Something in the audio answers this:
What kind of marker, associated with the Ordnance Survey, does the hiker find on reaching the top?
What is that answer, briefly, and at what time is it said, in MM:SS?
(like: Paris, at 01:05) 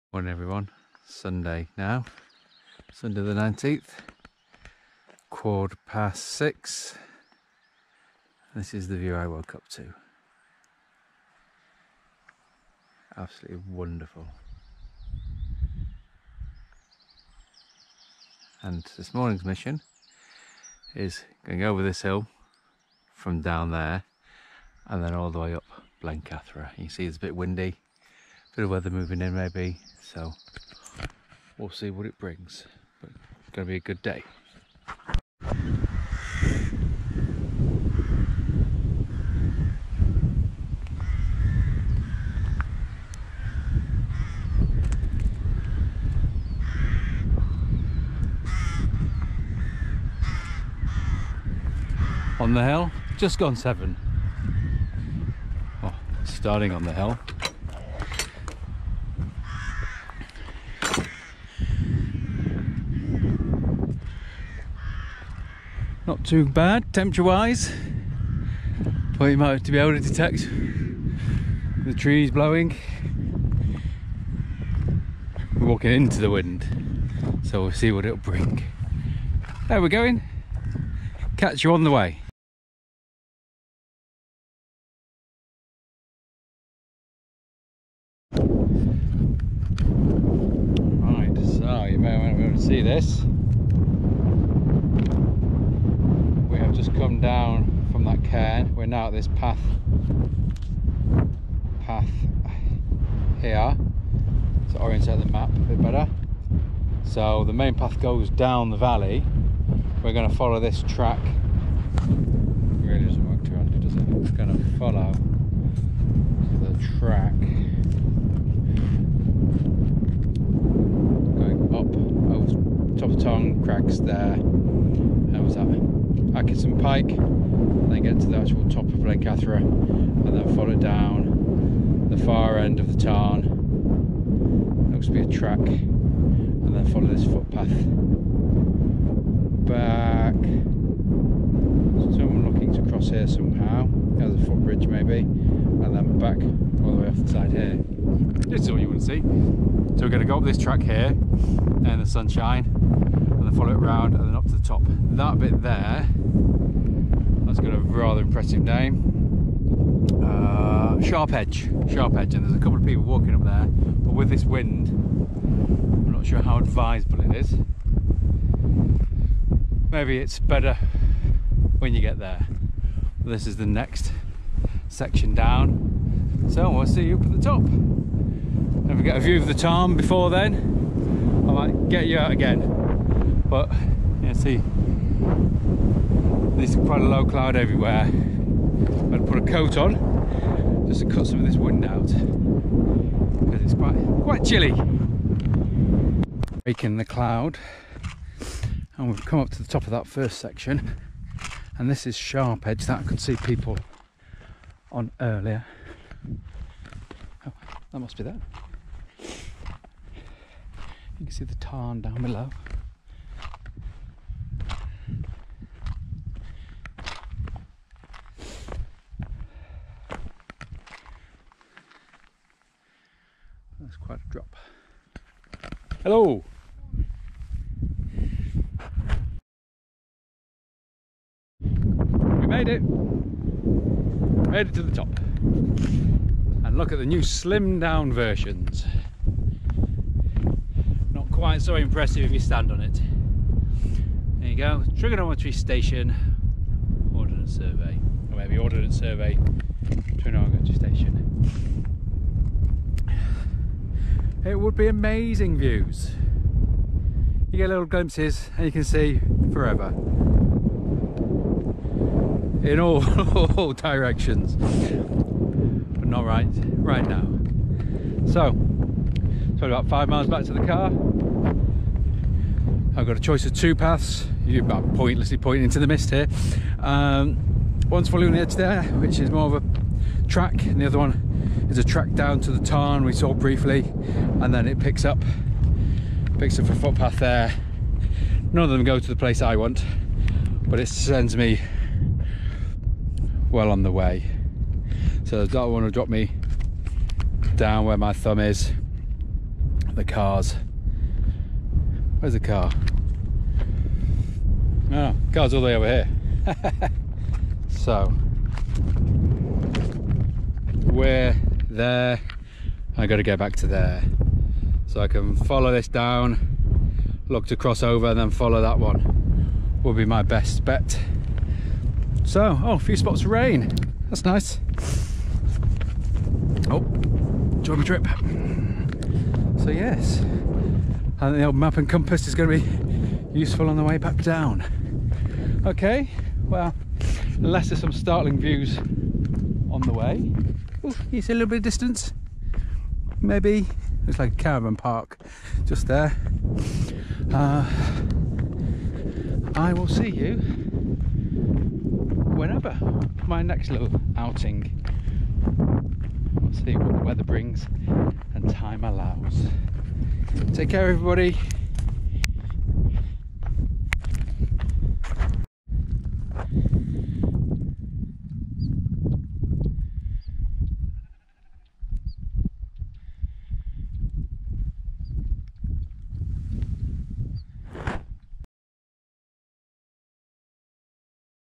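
trigonometry station, at 04:04.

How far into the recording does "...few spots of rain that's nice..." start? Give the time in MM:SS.
05:22.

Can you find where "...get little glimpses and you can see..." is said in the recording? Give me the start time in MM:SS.
04:17.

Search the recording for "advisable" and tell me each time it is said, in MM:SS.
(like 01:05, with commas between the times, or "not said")
02:46.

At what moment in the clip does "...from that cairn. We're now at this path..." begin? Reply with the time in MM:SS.
01:37.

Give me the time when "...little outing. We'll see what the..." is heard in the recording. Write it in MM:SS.
05:53.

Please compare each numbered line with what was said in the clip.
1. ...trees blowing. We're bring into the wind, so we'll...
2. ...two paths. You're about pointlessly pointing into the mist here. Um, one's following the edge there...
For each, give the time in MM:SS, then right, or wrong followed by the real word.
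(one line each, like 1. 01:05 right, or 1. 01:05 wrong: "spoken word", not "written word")
1. 01:11 wrong: "walking", not "bring"
2. 04:33 right.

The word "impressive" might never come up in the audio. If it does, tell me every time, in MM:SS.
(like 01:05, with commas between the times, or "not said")
02:38, 04:01.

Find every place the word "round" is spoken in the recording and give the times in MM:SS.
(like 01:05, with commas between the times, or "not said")
02:33.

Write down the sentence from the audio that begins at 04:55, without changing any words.
So the dark one will drop me down where my thumb is.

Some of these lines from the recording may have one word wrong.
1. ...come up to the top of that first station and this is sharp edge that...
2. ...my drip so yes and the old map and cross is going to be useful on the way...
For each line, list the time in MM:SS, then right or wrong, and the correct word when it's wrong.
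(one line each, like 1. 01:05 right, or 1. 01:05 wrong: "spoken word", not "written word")
1. 03:19 wrong: "section", not "station"
2. 05:27 wrong: "compass", not "cross".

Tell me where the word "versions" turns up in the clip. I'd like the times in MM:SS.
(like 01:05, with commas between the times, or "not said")
03:58.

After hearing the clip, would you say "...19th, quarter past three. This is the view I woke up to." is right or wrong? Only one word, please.
wrong.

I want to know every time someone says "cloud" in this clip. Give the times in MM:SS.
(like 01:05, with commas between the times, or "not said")
03:07, 03:17.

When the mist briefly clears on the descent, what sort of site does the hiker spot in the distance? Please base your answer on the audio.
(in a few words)
caravan park.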